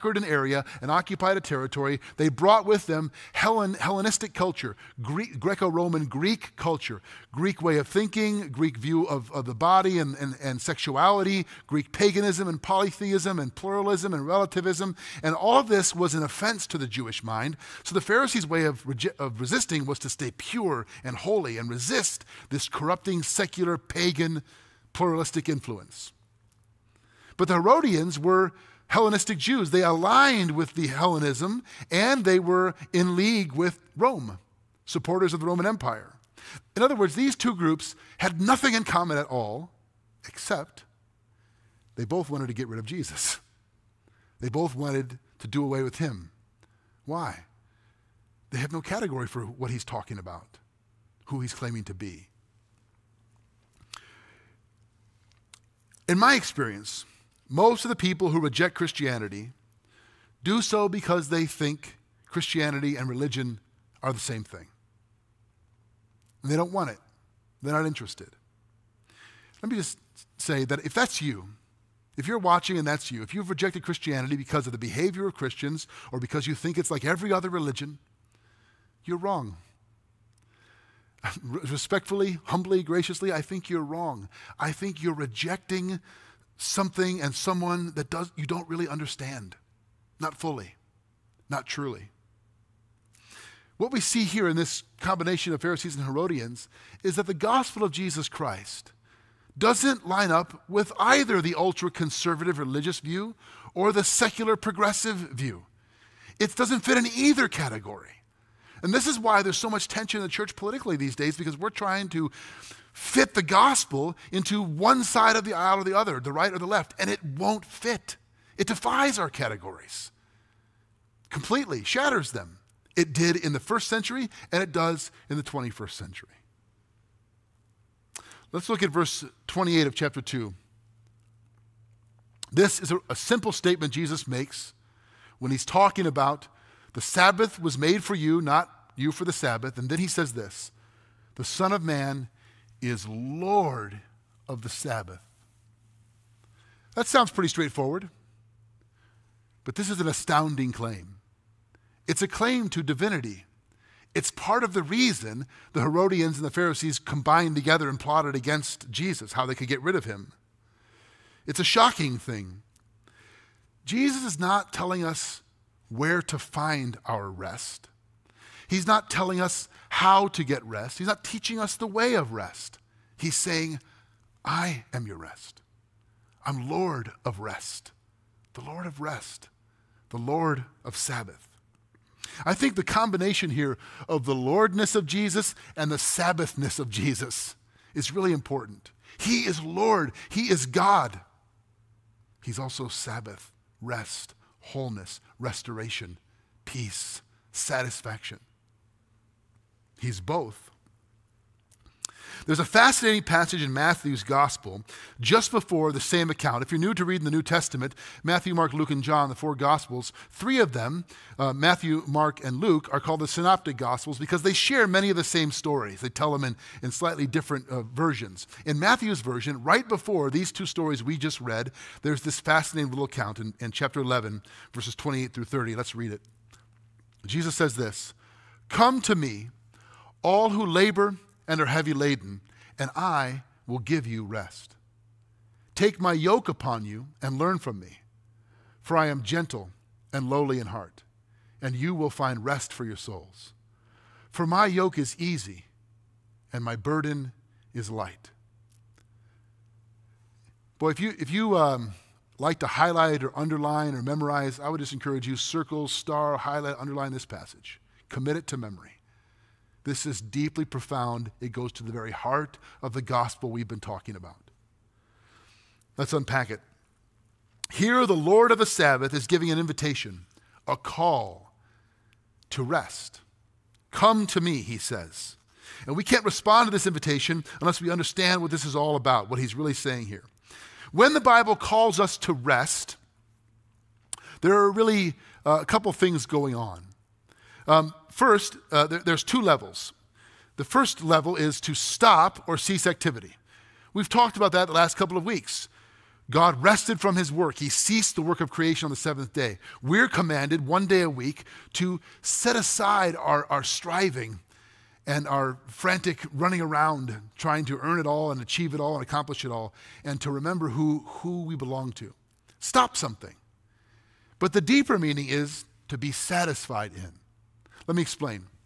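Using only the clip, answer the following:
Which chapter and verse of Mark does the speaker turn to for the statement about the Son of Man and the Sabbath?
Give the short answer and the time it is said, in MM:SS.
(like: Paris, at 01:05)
Verse 28 of chapter 2, at 02:08.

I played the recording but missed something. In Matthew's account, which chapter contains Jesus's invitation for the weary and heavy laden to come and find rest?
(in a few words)
Chapter 11.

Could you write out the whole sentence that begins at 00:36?
In other words, these two groups had nothing in common at all, except they both wanted to get rid of Jesus.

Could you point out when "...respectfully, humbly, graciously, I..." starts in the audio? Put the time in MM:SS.
01:21.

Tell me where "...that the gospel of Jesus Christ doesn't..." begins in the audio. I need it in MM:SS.
01:37.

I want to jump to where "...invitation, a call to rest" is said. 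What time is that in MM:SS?
04:29.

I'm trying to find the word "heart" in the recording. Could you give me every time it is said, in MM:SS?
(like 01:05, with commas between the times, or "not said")
04:00, 04:22.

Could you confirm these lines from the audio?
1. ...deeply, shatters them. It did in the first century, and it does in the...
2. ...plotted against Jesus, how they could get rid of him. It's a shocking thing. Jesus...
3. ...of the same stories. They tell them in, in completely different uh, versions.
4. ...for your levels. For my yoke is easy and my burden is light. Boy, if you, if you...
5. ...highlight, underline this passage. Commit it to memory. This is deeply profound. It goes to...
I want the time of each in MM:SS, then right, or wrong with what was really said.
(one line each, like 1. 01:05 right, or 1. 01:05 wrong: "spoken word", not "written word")
1. 02:01 wrong: "completely", not "deeply"
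2. 02:37 right
3. 03:35 wrong: "slightly", not "completely"
4. 04:02 wrong: "souls", not "levels"
5. 04:16 right.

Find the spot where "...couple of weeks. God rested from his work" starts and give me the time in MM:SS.
04:54.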